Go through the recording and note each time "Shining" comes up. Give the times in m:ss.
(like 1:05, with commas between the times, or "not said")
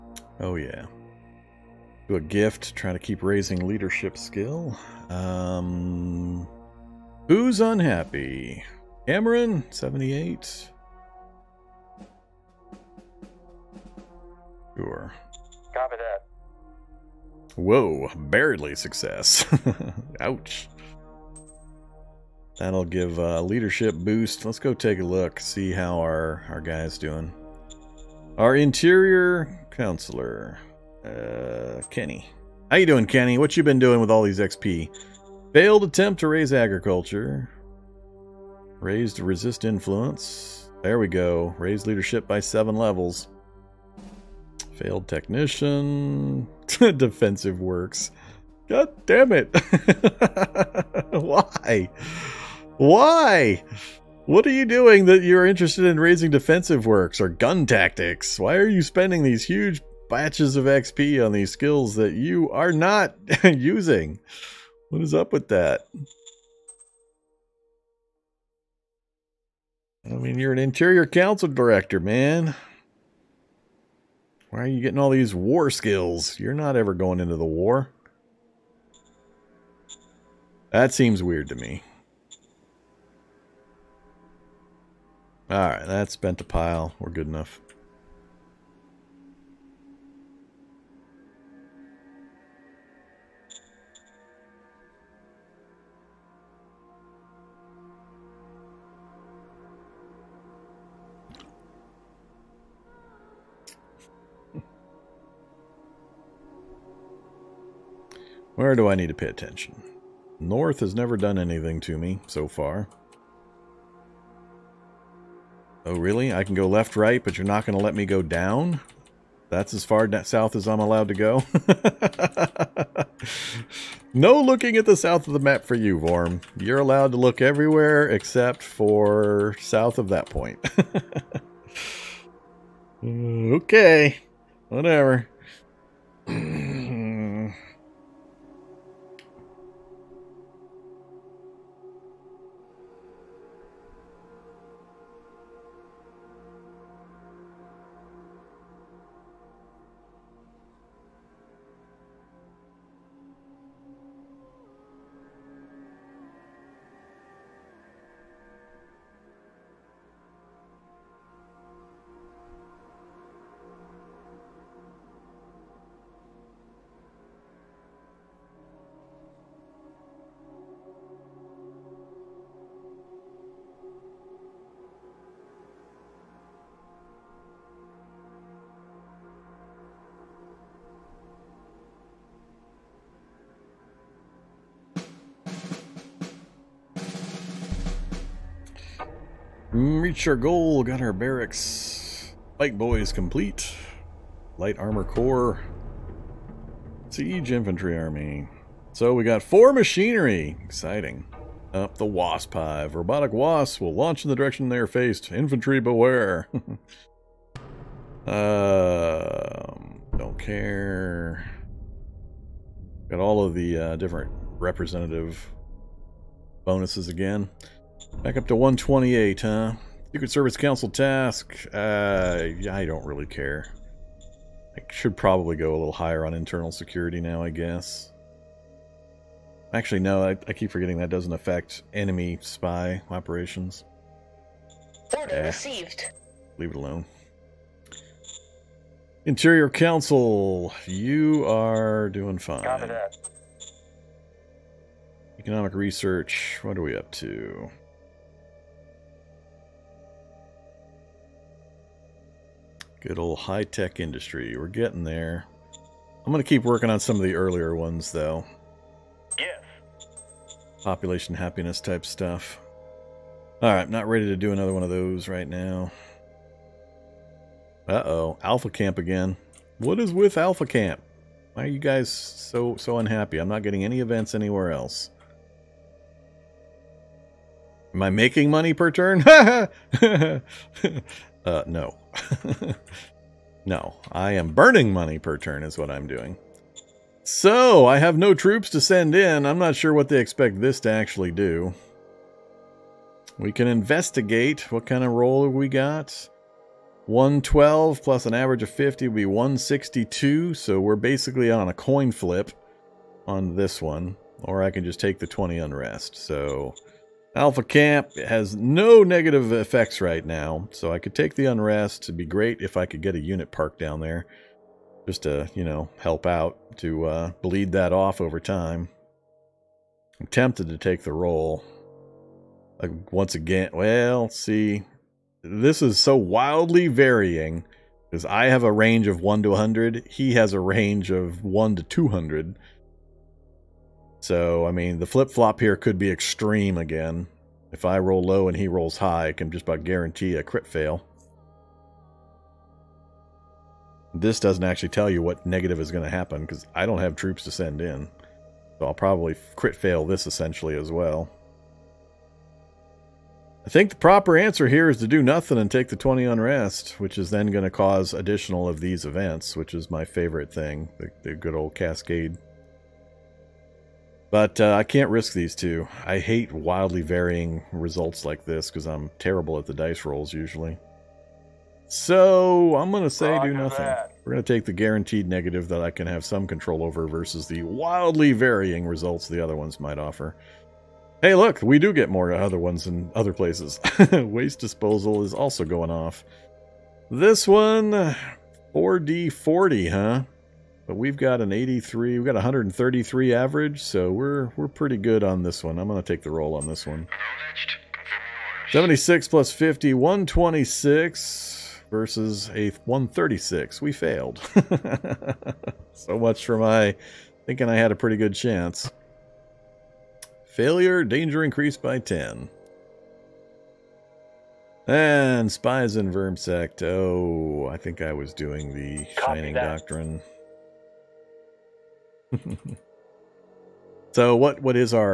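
6:59.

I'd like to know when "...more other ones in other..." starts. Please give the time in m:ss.
6:22.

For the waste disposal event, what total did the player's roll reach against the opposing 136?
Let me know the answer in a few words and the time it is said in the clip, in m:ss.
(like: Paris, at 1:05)
126, at 6:39.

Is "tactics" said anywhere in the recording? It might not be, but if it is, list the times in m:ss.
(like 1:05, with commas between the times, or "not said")
0:57.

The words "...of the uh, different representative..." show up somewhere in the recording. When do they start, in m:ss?
3:33.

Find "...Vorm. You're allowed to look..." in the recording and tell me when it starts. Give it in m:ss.
2:05.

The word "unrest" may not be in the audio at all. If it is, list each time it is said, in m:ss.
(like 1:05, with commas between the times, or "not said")
5:05, 5:11, 5:56.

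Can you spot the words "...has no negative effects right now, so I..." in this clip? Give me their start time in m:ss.
5:08.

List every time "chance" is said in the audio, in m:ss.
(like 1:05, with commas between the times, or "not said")
6:48.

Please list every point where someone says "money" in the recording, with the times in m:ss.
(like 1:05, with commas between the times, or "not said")
4:38, 4:44.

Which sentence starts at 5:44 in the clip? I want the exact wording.
This doesn't actually tell you what negative is going to happen, because I don't have troops to send in.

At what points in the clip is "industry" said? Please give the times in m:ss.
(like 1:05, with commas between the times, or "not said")
4:13.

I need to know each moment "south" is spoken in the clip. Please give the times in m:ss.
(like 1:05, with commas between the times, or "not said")
2:00, 2:04, 2:09.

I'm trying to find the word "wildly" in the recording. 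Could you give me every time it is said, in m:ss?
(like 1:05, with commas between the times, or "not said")
5:26, 6:06, 6:17.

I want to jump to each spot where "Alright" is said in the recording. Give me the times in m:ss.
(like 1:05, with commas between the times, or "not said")
1:25, 4:23.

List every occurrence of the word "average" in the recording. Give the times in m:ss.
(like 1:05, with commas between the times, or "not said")
4:58, 6:33.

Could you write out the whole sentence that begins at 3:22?
Robotic wasps will launch in the direction they are faced.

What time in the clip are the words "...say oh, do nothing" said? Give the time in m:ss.
6:13.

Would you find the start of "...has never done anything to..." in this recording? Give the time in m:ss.
1:50.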